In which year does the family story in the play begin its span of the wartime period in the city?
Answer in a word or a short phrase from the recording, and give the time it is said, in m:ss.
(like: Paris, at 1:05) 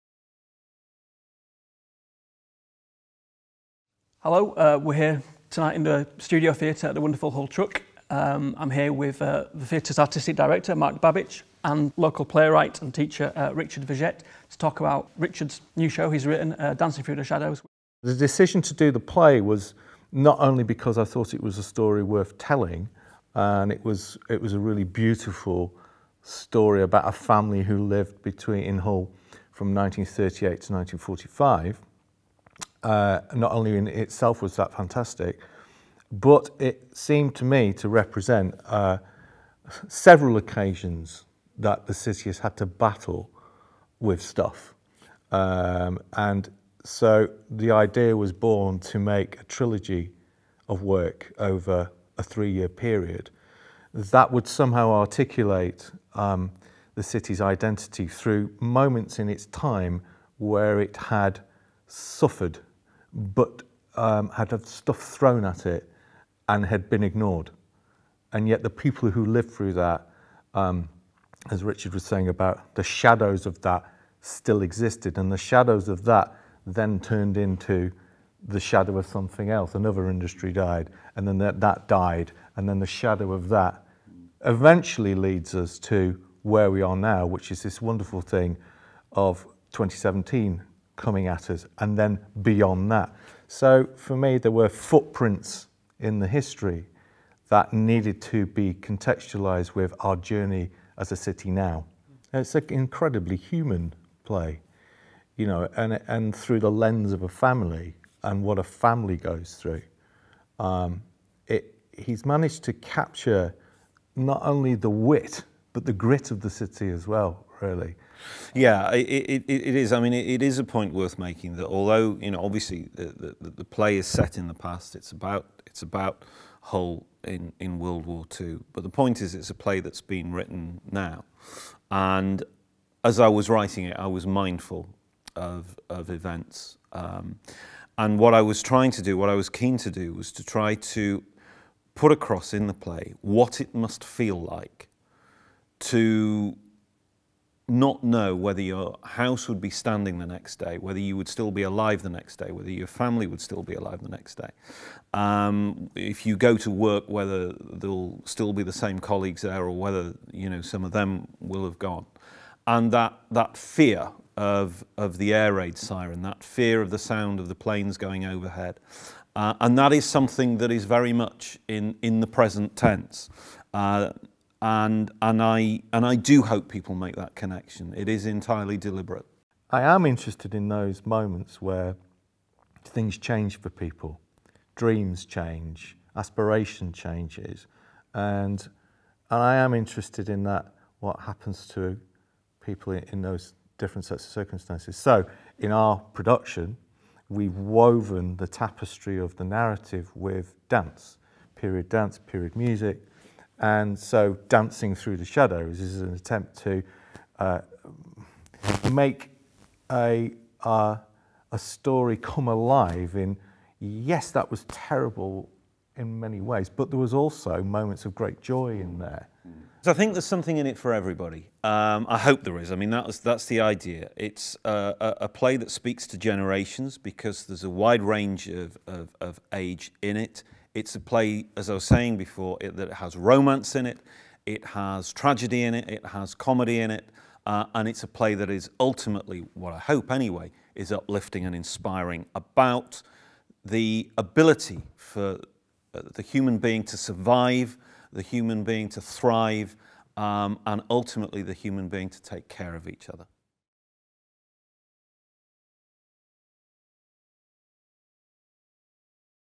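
1938, at 0:29.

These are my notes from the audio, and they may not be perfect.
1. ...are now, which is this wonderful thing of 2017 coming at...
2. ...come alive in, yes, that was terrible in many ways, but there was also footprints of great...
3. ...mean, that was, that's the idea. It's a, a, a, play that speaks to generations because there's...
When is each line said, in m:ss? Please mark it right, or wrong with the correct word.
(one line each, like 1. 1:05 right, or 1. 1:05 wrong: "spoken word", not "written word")
1. 1:26 right
2. 3:32 wrong: "moments", not "footprints"
3. 3:42 right.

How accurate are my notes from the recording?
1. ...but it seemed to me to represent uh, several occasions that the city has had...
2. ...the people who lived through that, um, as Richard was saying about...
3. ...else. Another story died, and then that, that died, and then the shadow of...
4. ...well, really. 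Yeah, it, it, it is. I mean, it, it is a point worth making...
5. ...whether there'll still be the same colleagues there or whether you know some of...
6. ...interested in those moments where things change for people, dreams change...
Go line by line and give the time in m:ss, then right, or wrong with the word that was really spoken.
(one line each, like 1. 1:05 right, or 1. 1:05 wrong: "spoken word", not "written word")
1. 0:36 right
2. 1:08 right
3. 1:19 wrong: "industry", not "story"
4. 1:57 right
5. 2:37 right
6. 3:00 right.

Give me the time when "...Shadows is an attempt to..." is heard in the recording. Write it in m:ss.
3:25.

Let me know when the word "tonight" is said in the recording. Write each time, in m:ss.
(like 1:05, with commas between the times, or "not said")
0:05.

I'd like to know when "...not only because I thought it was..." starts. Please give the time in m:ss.
0:20.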